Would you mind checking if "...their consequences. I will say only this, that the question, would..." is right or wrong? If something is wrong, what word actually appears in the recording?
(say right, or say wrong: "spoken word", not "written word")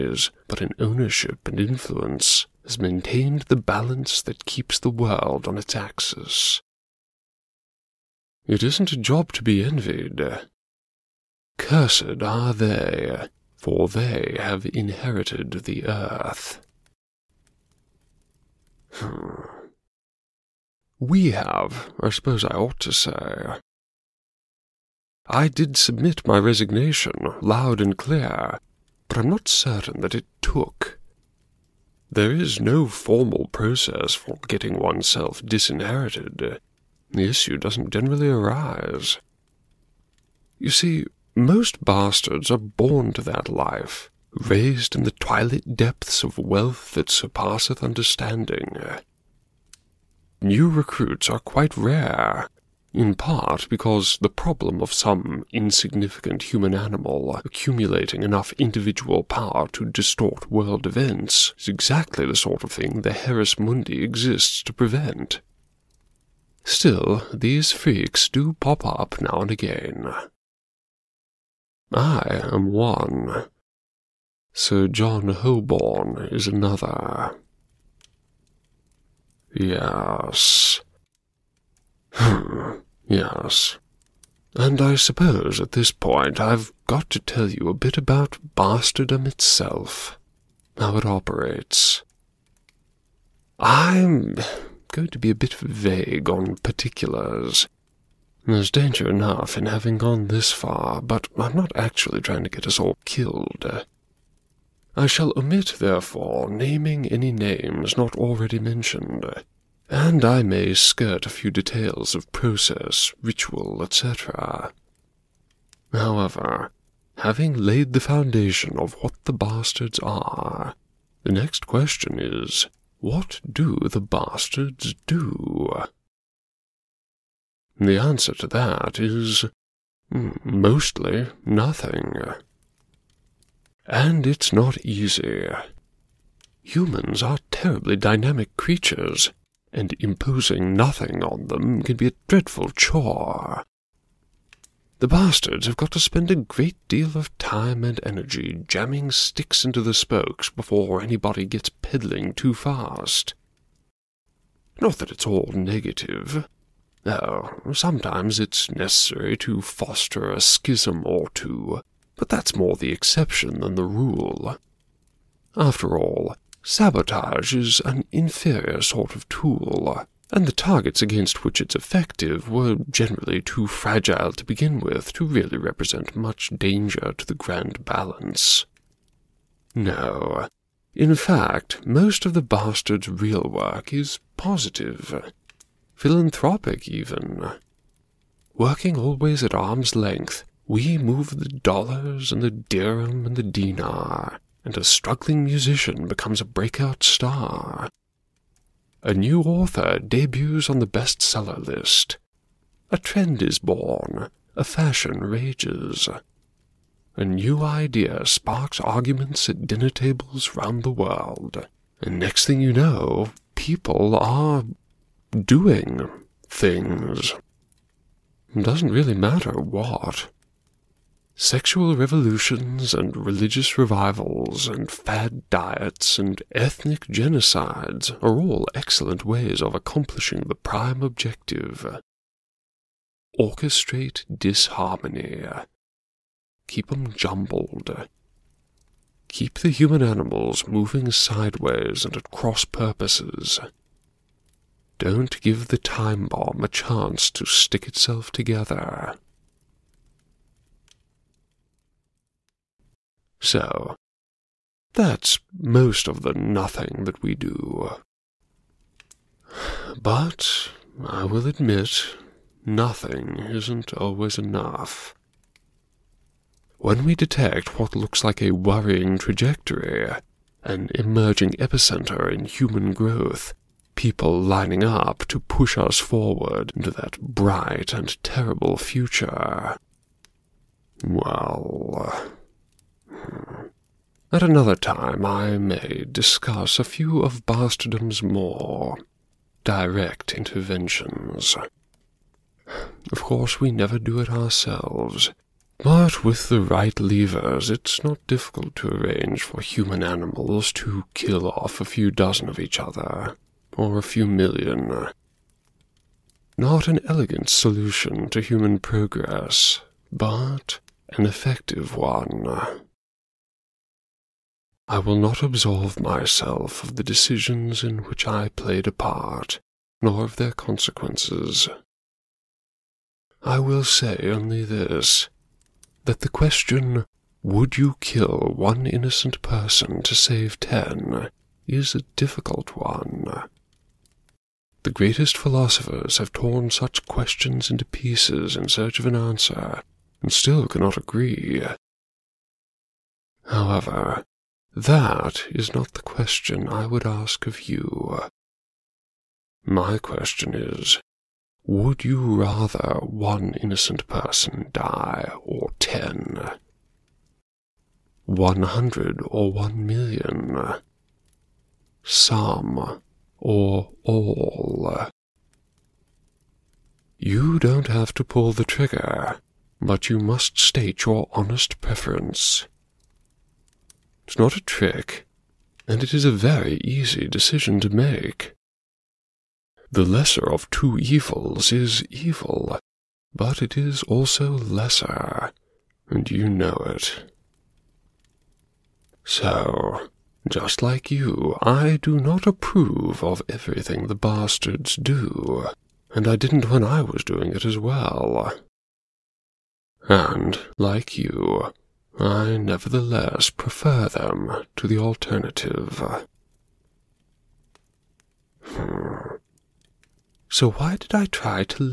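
right.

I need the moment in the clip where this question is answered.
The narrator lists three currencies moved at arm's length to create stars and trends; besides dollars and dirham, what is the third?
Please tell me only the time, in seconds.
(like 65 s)
193 s.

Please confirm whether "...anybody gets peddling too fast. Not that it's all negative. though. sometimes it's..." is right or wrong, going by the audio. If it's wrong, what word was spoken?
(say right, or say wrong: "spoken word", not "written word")
right.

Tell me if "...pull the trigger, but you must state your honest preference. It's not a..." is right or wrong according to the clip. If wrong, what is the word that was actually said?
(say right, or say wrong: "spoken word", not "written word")
right.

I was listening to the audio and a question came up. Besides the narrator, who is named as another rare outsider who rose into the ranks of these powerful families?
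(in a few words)
Sir John Holborn.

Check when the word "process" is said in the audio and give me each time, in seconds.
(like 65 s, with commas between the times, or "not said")
33 s, 112 s.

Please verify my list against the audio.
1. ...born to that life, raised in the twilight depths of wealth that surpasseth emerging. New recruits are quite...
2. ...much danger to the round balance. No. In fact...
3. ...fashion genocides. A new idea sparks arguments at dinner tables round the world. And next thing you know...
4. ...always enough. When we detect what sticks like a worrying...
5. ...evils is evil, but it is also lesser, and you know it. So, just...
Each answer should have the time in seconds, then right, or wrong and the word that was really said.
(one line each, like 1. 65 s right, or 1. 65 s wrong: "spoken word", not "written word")
1. 42 s wrong: "understanding", not "emerging"
2. 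176 s wrong: "grand", not "round"
3. 204 s wrong: "rages", not "genocides"
4. 263 s wrong: "looks", not "sticks"
5. 380 s right.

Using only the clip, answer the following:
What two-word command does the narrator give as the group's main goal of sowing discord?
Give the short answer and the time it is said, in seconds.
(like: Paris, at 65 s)
Orchestrate disharmony, at 233 s.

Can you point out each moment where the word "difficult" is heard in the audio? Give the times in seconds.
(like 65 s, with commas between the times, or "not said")
298 s, 332 s.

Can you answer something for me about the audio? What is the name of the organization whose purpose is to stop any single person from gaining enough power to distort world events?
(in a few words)
Heres Mundi.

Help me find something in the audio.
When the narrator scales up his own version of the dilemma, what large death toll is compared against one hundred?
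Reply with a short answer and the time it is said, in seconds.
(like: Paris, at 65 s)
1,000,000, at 359 s.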